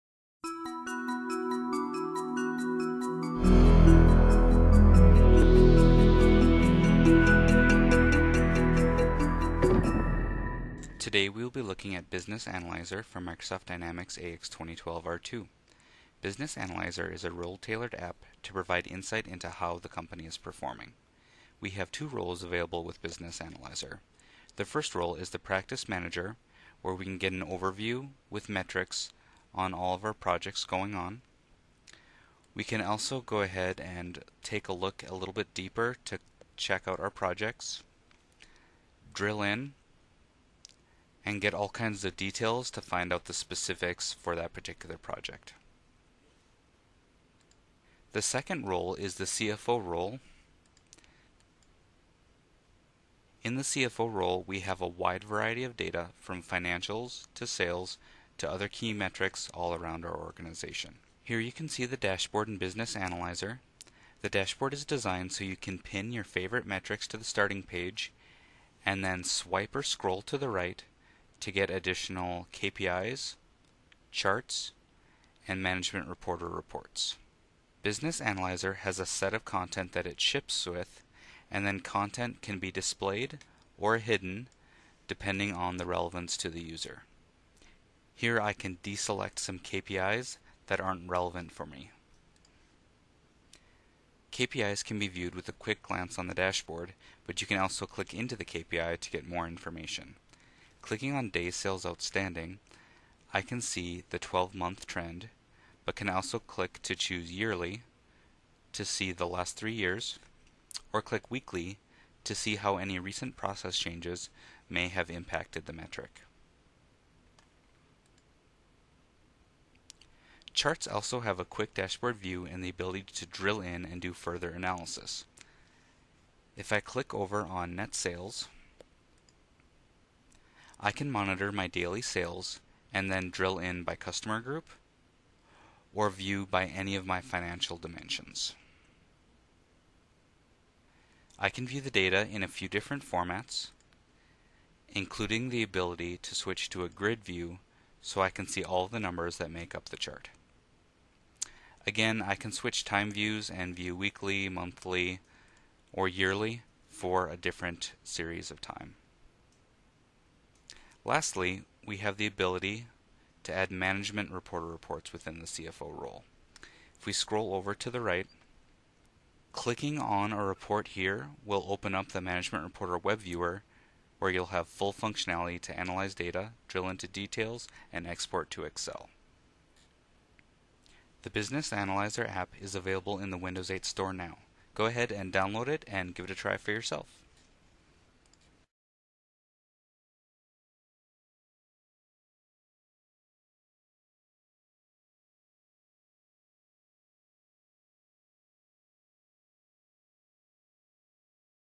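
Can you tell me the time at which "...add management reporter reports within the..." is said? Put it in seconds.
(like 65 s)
163 s.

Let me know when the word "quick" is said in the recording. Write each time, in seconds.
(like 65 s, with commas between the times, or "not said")
95 s, 121 s.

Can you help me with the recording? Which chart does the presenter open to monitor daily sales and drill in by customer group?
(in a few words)
Net Sales.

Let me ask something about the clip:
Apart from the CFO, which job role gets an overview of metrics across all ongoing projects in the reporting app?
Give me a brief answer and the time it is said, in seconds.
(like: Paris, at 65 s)
Practice Manager, at 25 s.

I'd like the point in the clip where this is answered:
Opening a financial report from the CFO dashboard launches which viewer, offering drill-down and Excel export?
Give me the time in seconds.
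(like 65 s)
172 s.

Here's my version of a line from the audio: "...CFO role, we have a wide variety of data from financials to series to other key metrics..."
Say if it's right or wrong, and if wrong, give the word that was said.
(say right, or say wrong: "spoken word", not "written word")
wrong: "sales", not "series".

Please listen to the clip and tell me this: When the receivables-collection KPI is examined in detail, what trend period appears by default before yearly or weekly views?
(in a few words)
12-month trend.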